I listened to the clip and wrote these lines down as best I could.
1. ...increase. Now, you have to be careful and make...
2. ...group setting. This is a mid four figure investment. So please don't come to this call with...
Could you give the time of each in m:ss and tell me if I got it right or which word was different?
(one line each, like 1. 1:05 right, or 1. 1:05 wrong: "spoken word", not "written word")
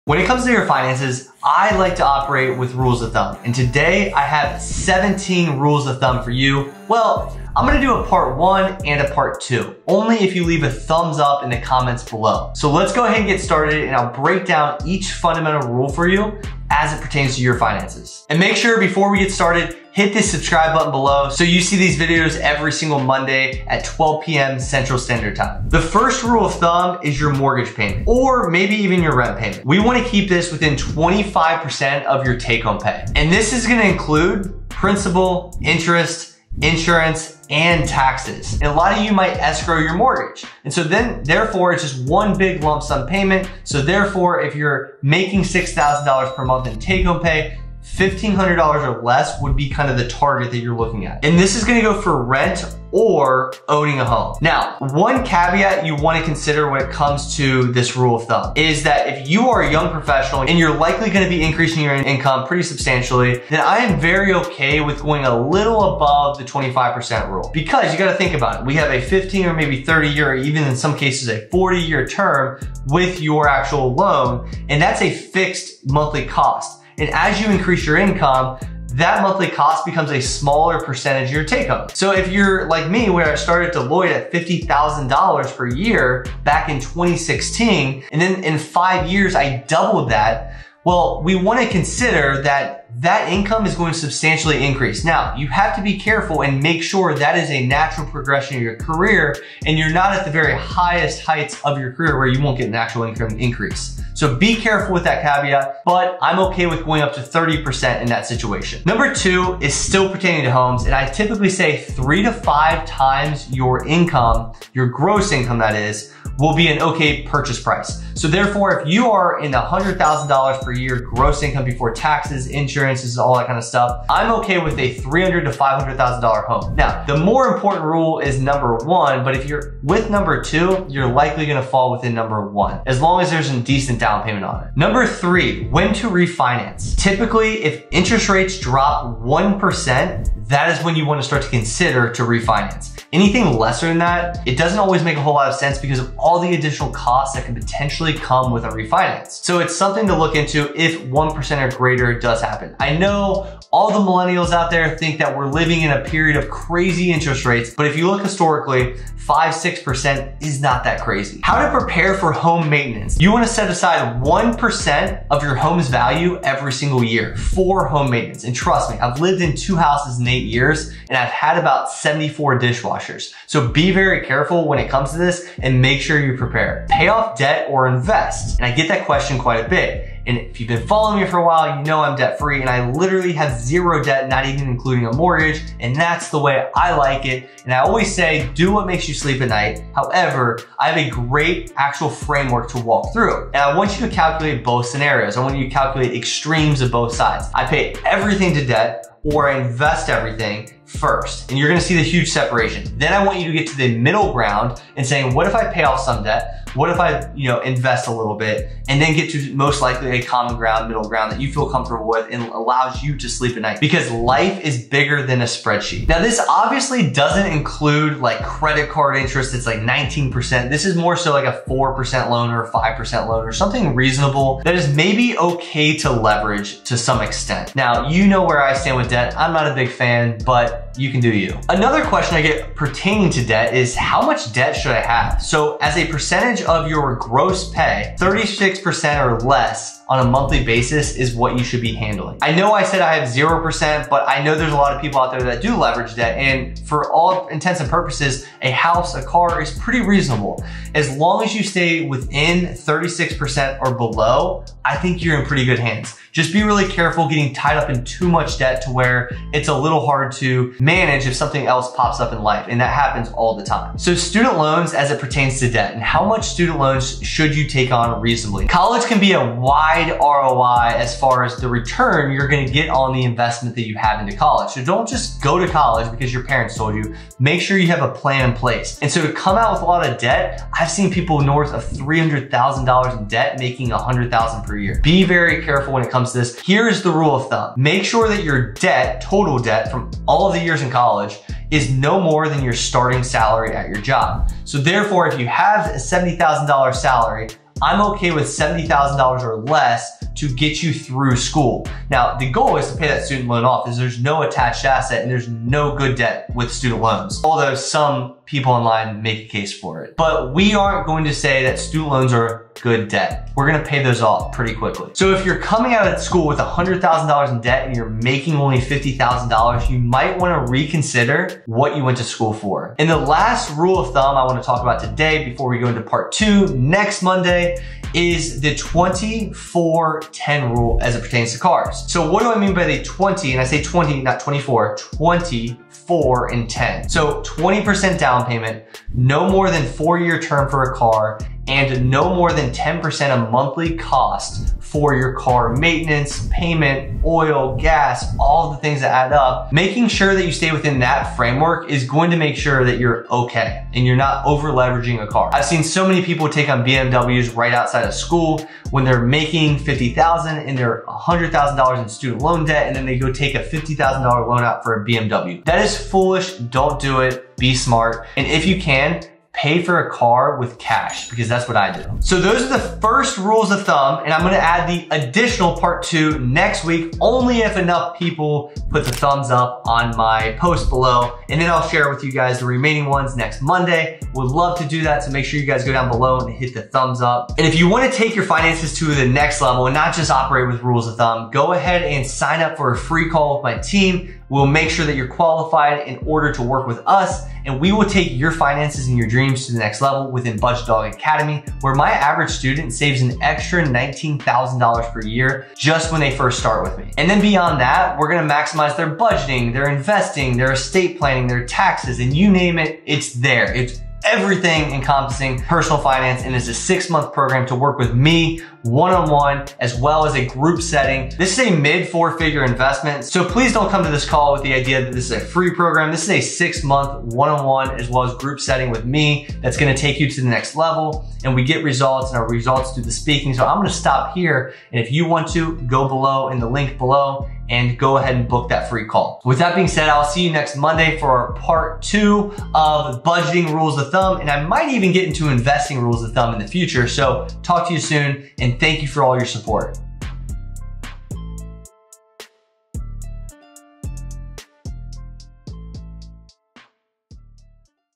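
1. 1:34 right
2. 7:00 right.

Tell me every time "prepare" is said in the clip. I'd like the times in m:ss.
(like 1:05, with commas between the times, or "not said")
2:41, 2:56.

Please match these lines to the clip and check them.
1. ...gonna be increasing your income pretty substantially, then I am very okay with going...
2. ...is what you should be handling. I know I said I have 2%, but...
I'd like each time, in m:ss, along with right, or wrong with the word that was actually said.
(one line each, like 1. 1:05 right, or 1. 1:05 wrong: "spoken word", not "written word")
1. 1:01 right
2. 4:01 wrong: "0", not "2".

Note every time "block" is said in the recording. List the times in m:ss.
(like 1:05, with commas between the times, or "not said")
not said.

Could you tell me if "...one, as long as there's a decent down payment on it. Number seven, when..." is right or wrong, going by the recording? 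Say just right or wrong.
wrong.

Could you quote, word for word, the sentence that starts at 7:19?
With that being said, I'll see you next Monday for part two of budgeting rules of thumb.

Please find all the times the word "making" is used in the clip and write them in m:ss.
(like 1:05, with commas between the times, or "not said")
0:45, 4:43, 5:18, 5:49, 5:59.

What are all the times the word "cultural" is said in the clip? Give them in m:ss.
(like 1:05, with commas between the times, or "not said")
not said.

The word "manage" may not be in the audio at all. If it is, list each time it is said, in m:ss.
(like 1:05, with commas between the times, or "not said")
4:20.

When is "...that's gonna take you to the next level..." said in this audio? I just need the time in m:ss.
7:09.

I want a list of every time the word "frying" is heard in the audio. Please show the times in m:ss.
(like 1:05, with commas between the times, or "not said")
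not said.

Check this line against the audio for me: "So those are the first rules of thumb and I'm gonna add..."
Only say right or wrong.
right.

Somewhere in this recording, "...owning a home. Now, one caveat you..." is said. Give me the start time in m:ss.
0:53.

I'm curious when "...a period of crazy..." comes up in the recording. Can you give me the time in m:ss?
2:35.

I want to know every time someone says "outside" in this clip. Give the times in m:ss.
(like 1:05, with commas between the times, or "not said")
5:57.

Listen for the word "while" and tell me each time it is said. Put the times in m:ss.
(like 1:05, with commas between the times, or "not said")
3:01.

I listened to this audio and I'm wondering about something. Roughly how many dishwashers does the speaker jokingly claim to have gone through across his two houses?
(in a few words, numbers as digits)
74.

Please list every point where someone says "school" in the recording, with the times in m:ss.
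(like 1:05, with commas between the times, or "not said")
5:01, 5:16, 5:22, 5:58.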